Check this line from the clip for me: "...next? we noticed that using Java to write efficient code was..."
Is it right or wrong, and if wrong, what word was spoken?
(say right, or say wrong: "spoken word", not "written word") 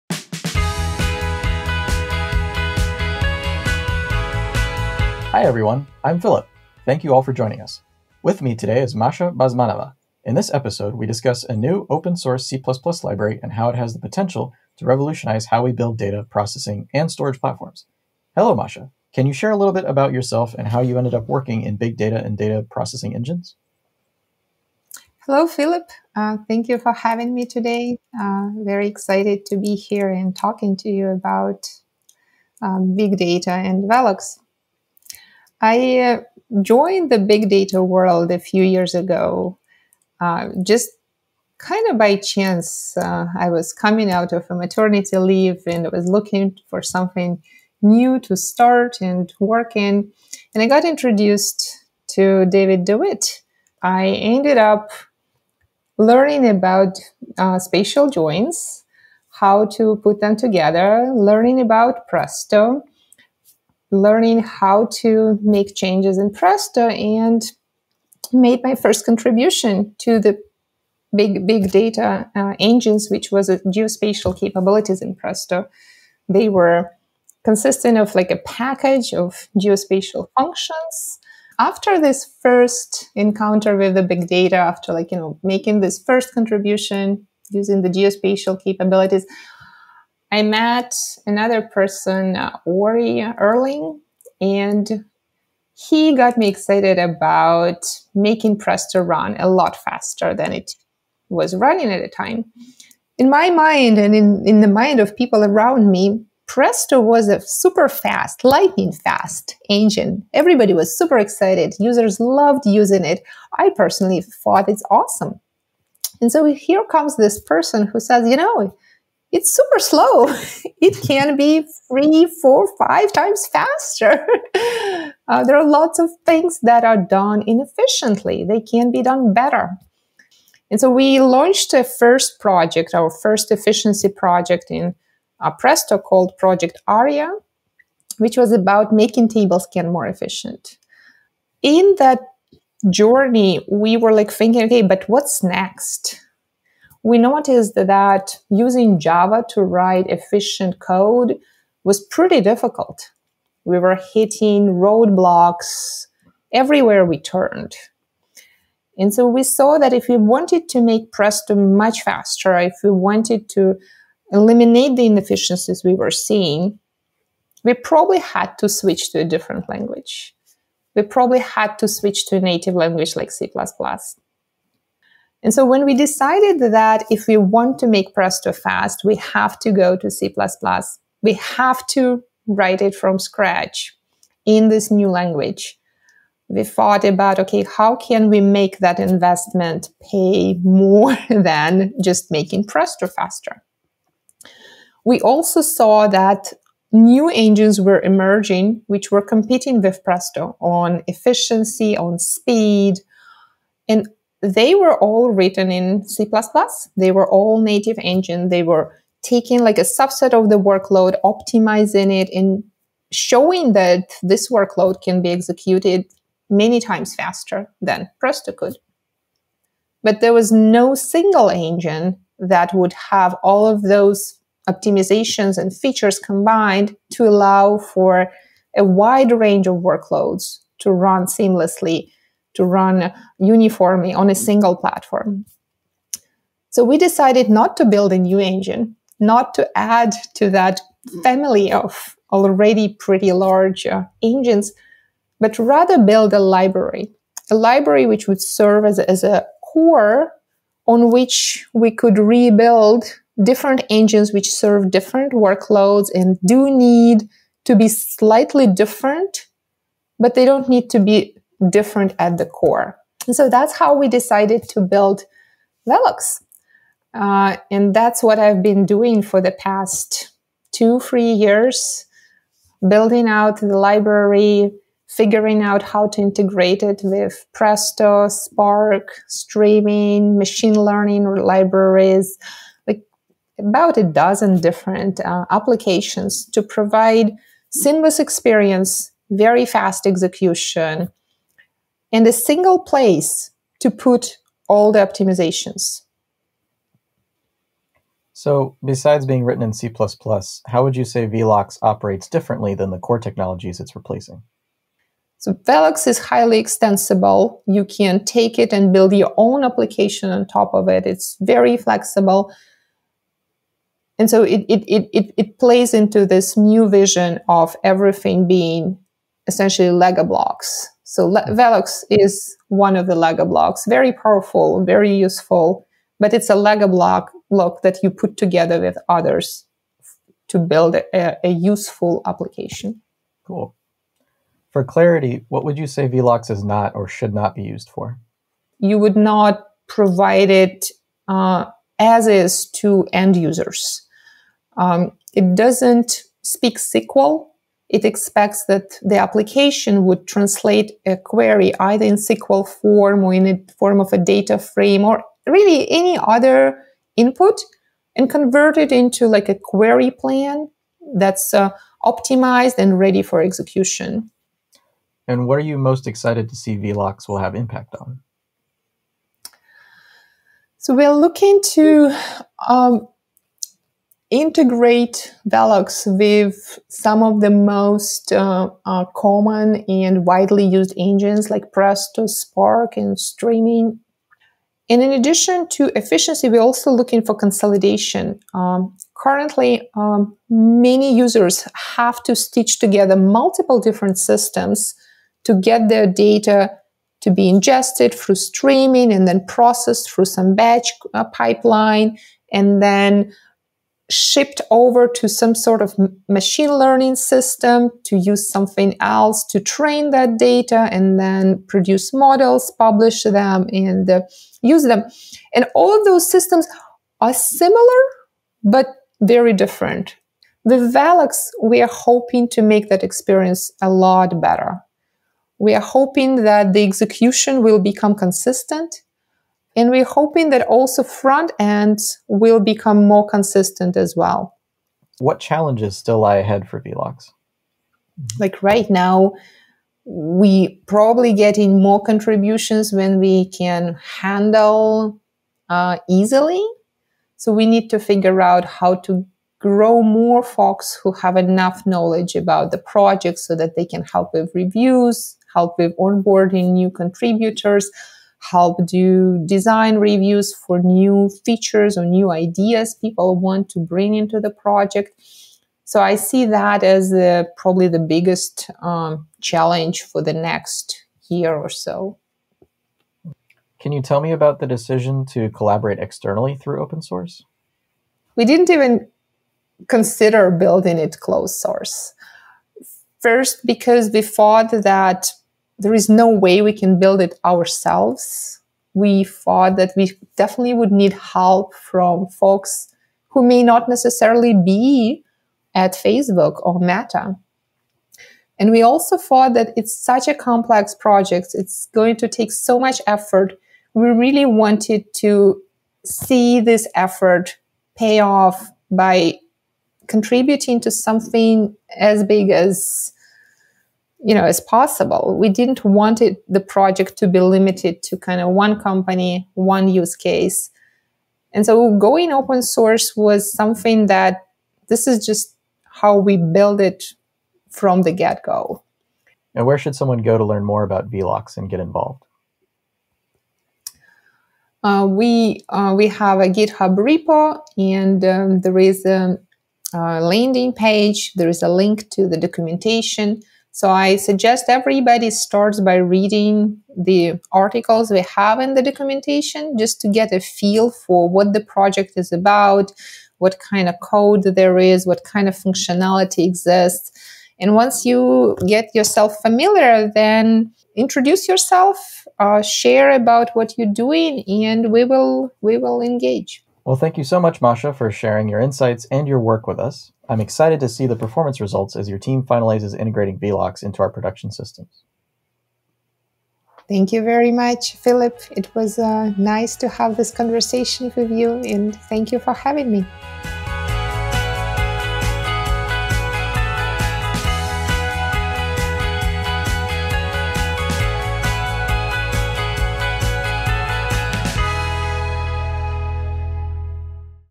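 right.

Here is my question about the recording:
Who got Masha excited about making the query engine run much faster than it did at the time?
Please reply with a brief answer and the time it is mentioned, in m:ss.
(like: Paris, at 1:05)
Orri Erling, at 1:32.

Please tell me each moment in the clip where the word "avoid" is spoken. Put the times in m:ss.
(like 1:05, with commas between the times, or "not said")
not said.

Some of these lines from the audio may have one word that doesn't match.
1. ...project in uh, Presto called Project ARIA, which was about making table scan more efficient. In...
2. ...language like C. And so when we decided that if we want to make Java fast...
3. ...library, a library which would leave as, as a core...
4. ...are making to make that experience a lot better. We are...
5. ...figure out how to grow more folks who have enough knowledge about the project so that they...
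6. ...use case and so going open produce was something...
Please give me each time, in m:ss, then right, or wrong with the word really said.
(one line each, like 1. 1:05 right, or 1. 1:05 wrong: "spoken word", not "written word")
1. 2:14 right
2. 2:52 wrong: "Presto", not "Java"
3. 4:06 wrong: "serve", not "leave"
4. 7:01 wrong: "hoping", not "making"
5. 7:27 right
6. 8:39 wrong: "source", not "produce".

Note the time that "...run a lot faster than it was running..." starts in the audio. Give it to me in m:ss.
1:39.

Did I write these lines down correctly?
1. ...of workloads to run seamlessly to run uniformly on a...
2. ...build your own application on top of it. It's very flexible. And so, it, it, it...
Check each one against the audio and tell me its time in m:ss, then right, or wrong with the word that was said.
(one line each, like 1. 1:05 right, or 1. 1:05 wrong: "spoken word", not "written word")
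1. 3:49 right
2. 5:08 right.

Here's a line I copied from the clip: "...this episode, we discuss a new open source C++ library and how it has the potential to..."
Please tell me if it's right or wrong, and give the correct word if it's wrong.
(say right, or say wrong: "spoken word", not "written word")
right.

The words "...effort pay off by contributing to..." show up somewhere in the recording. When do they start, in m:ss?
8:26.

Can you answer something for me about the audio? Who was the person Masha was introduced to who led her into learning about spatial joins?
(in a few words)
David DeWitt.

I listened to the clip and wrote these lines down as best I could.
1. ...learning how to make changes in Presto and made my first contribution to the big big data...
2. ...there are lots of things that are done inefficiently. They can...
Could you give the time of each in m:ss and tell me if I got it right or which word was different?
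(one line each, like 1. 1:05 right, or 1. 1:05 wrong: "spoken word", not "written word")
1. 1:03 right
2. 2:05 right.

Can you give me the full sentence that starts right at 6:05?
And what are you most excited to see Velox will have impact on?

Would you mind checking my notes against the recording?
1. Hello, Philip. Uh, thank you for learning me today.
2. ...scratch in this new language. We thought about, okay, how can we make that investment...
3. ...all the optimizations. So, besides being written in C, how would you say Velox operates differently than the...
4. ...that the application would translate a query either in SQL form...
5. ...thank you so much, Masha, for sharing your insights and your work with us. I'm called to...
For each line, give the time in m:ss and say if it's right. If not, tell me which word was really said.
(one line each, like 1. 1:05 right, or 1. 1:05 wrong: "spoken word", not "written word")
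1. 0:25 wrong: "having", not "learning"
2. 3:03 right
3. 4:54 right
4. 5:48 right
5. 9:26 wrong: "excited", not "called".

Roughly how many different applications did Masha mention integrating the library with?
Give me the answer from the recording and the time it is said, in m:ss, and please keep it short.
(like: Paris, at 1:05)
About a dozen, at 4:43.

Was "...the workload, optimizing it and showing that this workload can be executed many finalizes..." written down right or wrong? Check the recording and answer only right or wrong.
wrong.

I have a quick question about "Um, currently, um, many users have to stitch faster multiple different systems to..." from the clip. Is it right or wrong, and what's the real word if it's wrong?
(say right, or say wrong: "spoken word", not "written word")
wrong: "together", not "faster".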